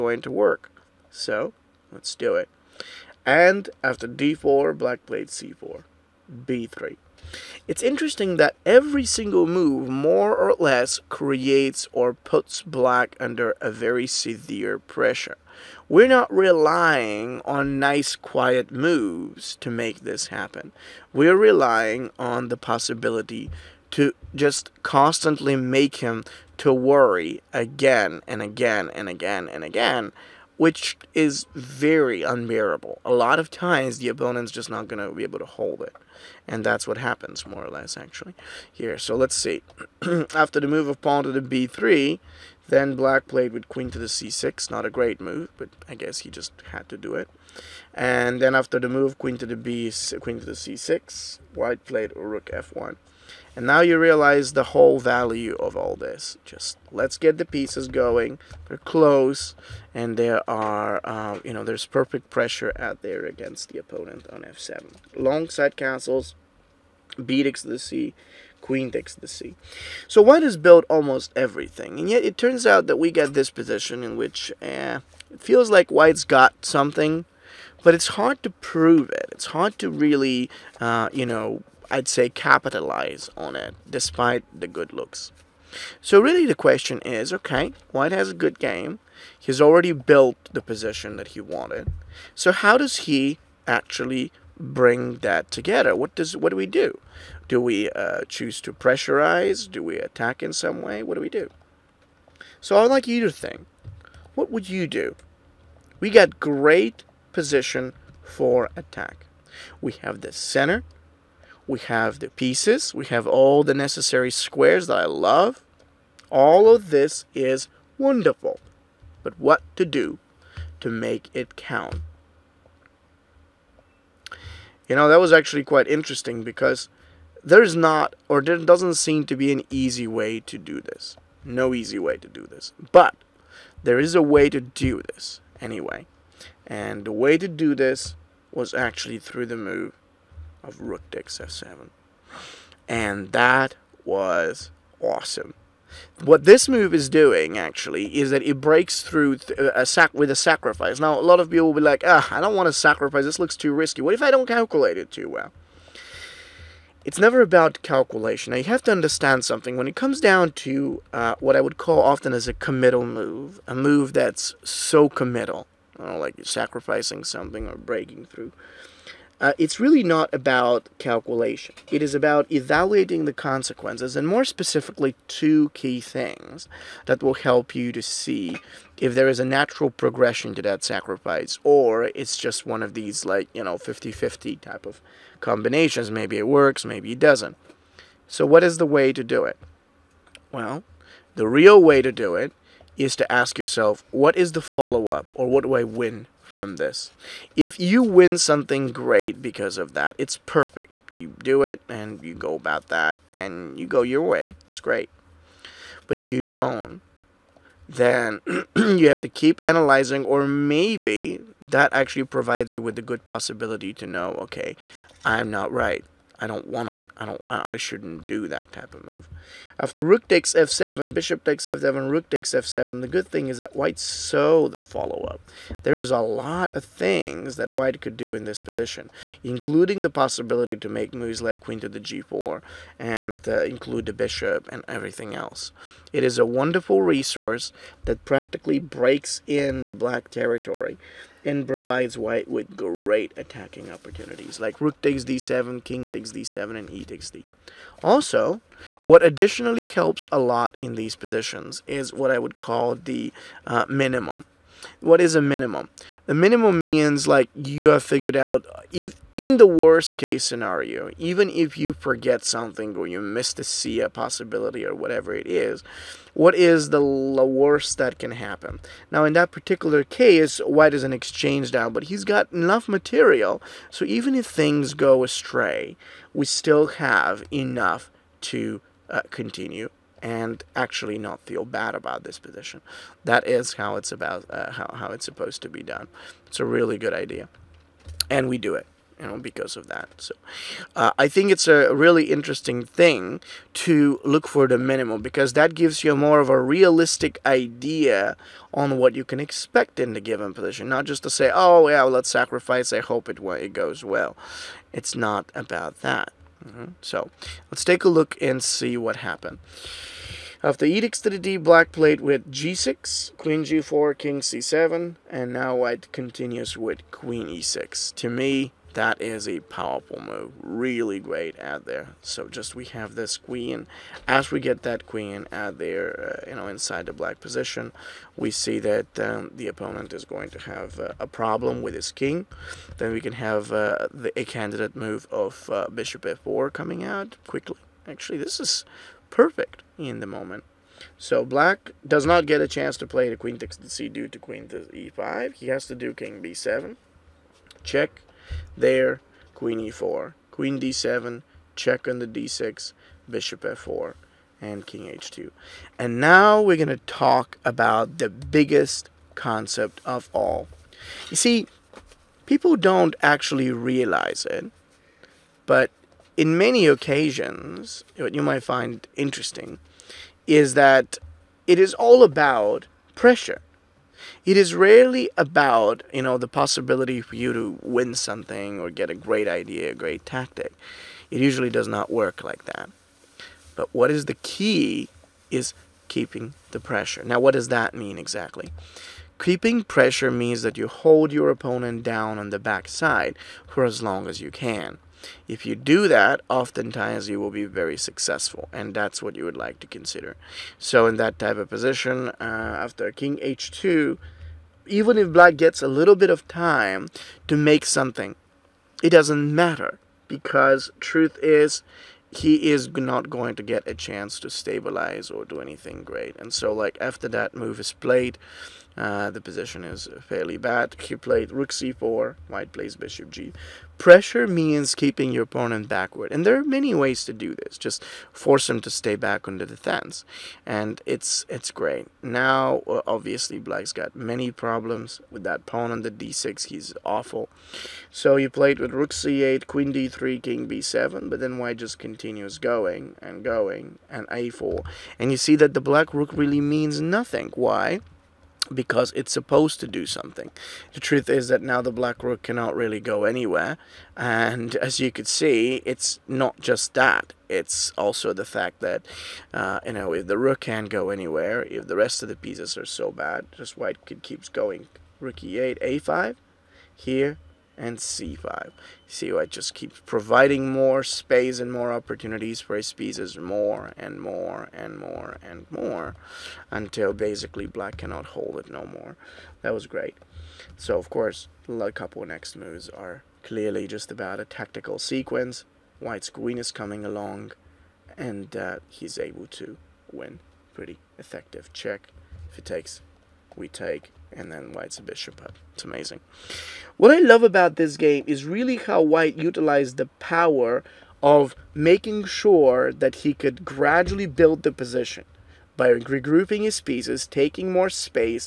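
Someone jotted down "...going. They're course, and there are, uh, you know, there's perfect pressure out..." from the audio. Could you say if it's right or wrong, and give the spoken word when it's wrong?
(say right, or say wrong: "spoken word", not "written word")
wrong: "close", not "course".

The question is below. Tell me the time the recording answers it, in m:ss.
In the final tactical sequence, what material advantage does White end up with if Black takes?
8:14.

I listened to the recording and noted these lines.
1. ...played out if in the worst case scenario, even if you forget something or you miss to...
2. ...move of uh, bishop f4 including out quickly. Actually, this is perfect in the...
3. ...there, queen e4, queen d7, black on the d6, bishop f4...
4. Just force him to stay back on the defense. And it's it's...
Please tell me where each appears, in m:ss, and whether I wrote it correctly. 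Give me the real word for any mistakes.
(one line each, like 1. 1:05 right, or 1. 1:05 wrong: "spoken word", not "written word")
1. 4:18 wrong: "figured", not "played"
2. 5:34 wrong: "coming", not "including"
3. 5:48 wrong: "check", not "black"
4. 7:07 right.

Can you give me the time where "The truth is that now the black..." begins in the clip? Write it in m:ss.
7:30.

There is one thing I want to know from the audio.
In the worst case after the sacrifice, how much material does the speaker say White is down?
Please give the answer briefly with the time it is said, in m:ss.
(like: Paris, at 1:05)
an exchange, at 4:31.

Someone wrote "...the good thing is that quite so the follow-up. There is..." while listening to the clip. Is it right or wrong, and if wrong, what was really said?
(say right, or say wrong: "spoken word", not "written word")
wrong: "white", not "quite".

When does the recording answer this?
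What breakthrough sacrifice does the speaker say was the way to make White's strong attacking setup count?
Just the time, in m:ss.
2:20.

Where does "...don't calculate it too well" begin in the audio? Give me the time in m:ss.
2:34.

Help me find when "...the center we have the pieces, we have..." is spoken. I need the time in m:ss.
1:50.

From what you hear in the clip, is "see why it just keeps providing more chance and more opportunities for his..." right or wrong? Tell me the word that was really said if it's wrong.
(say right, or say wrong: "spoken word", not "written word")
wrong: "space", not "chance".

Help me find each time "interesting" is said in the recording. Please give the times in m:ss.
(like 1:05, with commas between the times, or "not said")
0:07, 2:05, 4:52, 6:09.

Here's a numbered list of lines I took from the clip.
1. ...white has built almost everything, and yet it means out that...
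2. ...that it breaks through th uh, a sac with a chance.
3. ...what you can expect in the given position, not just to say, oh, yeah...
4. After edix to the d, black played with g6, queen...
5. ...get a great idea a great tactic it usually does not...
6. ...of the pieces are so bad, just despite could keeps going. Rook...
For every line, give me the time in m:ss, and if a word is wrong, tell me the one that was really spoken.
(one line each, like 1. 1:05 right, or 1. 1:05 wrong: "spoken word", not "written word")
1. 1:10 wrong: "turns", not "means"
2. 2:28 wrong: "sacrifice", not "chance"
3. 4:58 right
4. 5:10 right
5. 6:18 right
6. 7:42 wrong: "white", not "despite".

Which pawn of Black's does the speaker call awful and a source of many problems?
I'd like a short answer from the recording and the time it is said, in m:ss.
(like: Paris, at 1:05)
d6 pawn, at 7:15.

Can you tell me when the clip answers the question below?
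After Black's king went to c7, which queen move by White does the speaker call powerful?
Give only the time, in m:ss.
5:17.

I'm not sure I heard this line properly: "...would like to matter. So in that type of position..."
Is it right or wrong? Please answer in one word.
wrong.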